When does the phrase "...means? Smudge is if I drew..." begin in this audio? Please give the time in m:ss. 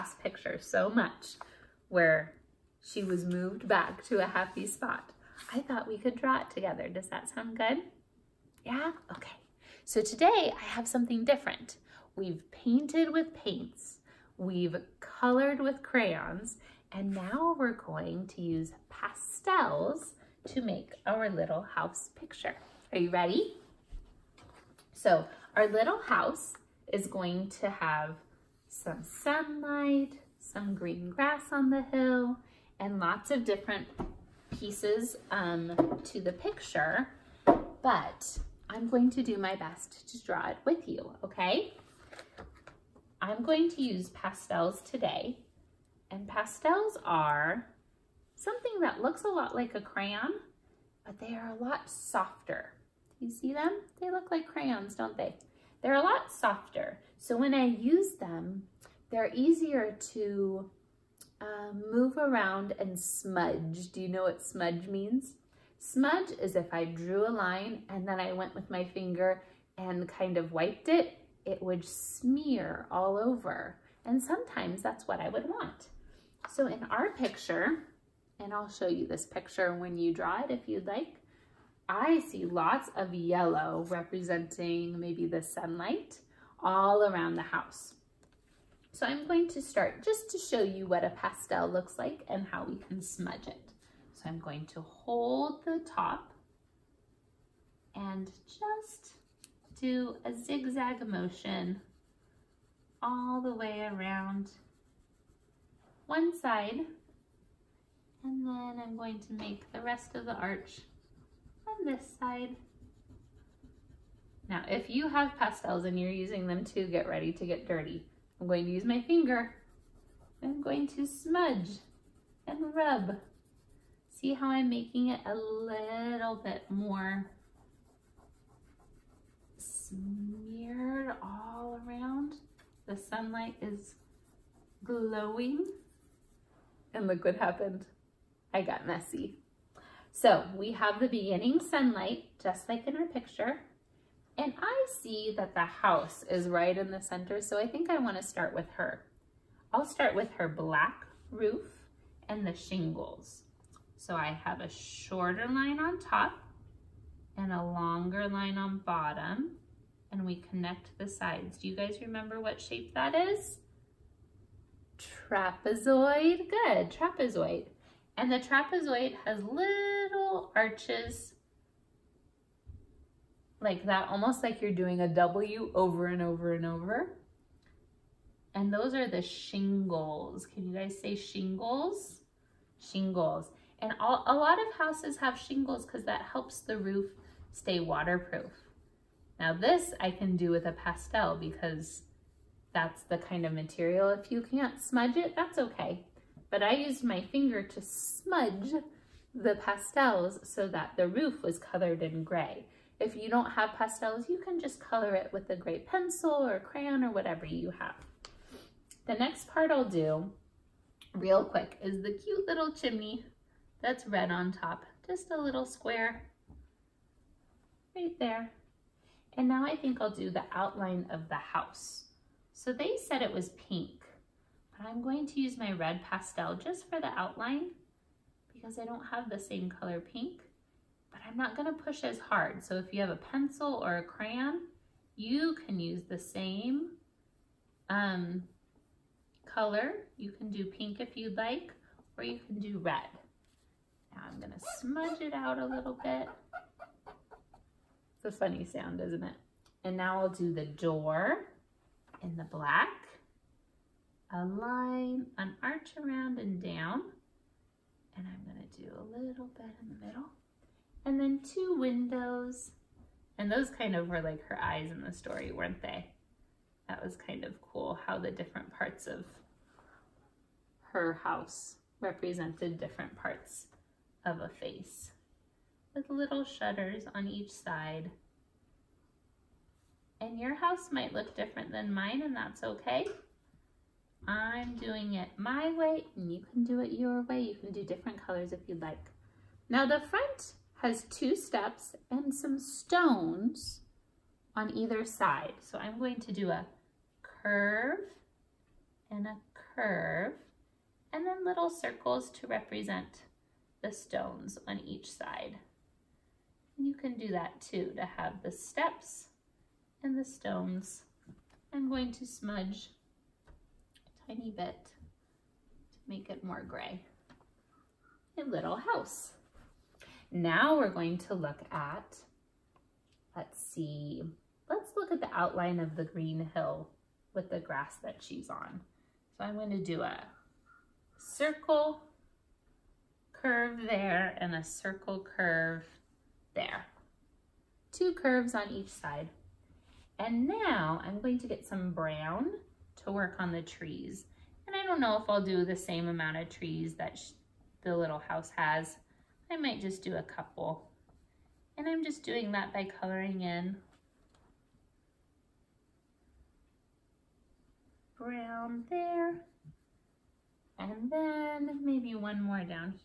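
1:04.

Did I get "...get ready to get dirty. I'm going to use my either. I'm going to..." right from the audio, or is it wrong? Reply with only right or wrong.
wrong.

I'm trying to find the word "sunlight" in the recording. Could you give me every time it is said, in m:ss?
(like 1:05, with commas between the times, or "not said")
0:29, 1:25, 2:12, 2:21.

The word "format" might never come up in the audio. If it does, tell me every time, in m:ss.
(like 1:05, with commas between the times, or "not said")
not said.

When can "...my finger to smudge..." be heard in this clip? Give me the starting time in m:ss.
3:17.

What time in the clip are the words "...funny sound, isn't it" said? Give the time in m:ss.
4:08.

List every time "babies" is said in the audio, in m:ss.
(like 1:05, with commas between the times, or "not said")
not said.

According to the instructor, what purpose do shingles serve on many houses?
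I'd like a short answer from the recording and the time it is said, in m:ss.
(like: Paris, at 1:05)
waterproof, at 3:07.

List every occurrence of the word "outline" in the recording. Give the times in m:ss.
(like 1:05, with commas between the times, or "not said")
3:40, 3:47, 5:25.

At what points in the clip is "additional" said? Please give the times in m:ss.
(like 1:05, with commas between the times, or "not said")
not said.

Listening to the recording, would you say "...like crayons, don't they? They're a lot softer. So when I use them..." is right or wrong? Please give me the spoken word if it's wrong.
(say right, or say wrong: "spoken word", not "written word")
right.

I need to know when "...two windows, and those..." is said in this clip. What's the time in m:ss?
4:21.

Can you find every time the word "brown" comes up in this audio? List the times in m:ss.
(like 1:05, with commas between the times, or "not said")
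5:41, 5:58.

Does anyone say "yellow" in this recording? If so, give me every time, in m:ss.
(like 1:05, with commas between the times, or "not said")
1:23.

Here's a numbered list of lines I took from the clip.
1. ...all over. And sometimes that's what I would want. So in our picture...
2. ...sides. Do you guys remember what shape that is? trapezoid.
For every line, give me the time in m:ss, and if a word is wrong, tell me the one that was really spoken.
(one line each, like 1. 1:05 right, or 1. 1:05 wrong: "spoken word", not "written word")
1. 1:12 right
2. 2:41 right.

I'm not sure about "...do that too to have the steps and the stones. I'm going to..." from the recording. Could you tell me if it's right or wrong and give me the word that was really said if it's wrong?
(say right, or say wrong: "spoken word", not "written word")
right.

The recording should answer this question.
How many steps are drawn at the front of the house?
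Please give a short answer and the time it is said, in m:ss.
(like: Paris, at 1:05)
2, at 4:51.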